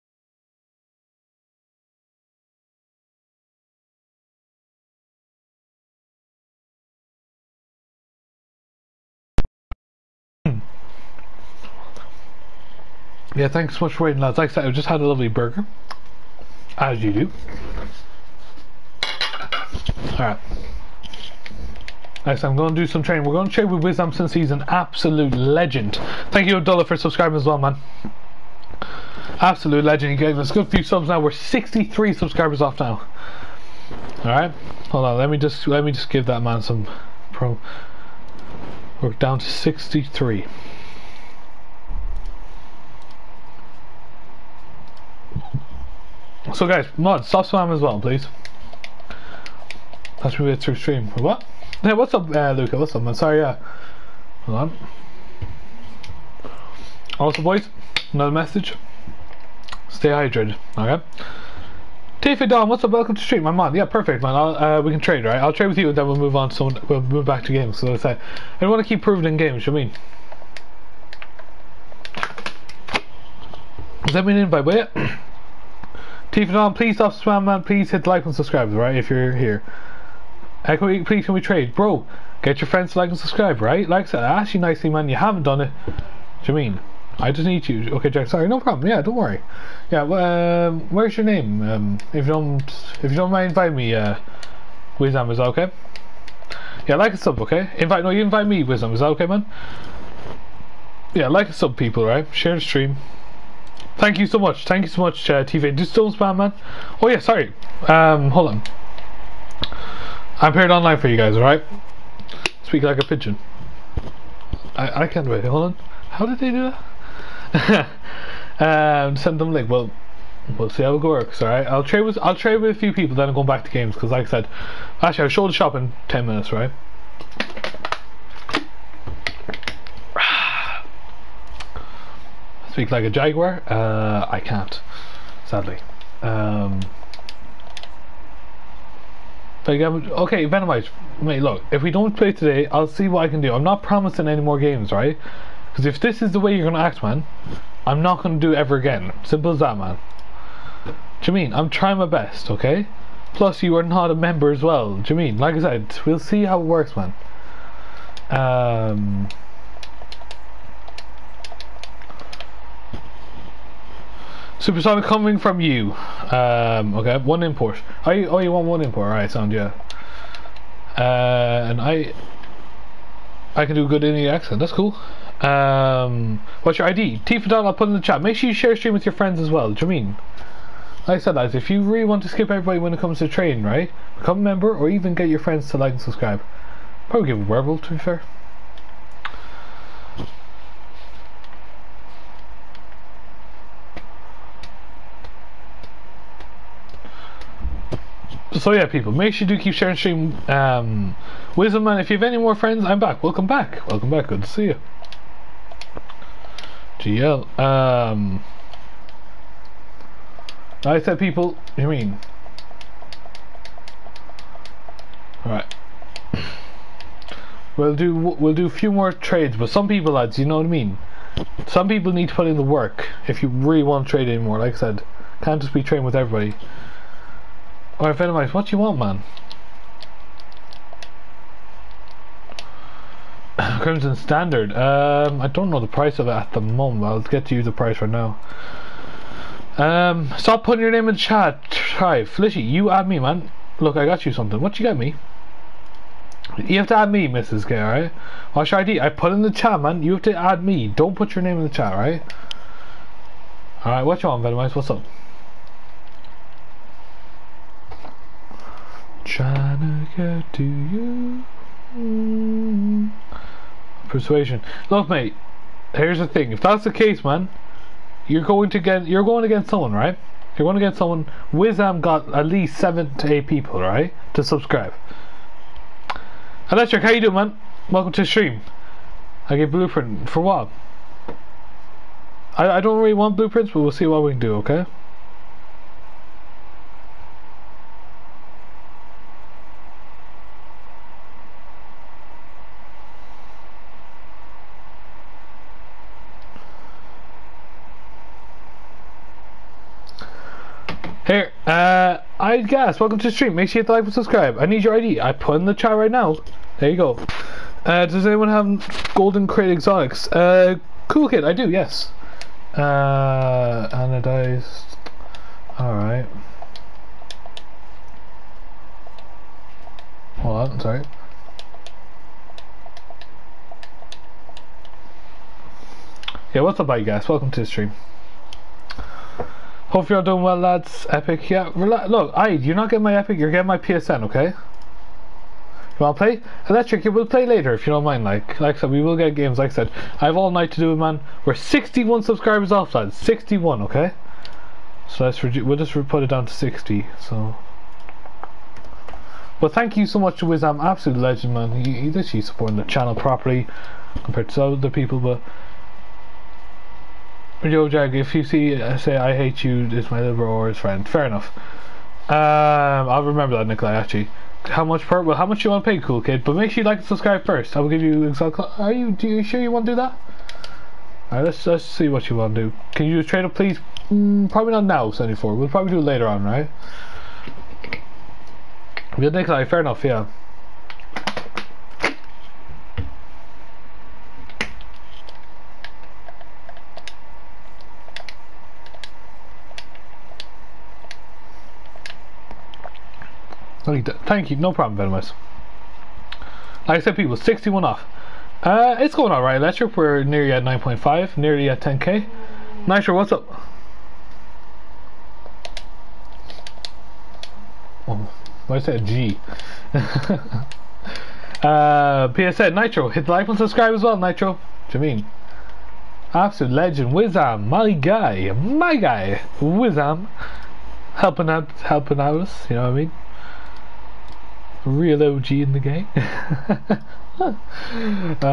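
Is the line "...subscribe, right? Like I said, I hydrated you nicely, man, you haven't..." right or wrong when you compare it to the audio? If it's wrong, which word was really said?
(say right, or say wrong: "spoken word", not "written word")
wrong: "asked", not "hydrated".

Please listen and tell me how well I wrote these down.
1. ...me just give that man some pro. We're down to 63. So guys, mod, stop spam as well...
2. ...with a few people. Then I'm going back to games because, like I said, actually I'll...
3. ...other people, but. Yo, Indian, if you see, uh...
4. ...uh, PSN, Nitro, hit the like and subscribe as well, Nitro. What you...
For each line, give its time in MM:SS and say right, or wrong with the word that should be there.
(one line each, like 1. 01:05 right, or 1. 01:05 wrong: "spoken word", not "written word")
1. 00:35 right
2. 02:02 right
3. 05:54 wrong: "Jag", not "Indian"
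4. 06:49 right.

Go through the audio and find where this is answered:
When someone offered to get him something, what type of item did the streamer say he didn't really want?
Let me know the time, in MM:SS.
04:43.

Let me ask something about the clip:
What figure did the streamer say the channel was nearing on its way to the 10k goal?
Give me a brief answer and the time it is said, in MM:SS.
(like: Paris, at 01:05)
9.5, at 06:40.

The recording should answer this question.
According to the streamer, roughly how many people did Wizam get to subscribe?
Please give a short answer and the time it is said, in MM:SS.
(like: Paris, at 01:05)
7 to 8, at 04:32.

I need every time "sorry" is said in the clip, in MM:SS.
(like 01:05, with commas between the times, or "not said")
00:53, 01:28, 01:47, 05:20.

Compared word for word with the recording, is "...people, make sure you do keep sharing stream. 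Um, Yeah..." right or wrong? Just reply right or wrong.
wrong.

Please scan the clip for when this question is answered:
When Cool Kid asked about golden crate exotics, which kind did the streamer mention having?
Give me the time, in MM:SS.
05:13.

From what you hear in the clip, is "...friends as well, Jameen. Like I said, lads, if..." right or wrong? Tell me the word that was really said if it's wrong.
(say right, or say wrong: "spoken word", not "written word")
right.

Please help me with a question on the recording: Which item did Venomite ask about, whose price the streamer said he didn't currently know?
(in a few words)
Crimson Standard.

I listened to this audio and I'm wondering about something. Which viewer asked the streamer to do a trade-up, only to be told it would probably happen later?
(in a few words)
74.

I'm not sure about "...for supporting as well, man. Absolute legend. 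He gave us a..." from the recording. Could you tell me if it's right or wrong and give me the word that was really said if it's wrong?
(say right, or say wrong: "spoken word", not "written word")
wrong: "subscribing", not "supporting".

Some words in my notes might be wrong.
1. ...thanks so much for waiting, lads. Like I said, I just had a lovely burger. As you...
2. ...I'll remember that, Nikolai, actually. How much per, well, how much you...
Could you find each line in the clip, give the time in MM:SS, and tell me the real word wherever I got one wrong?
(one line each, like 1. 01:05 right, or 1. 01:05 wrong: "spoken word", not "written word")
1. 00:13 right
2. 06:03 right.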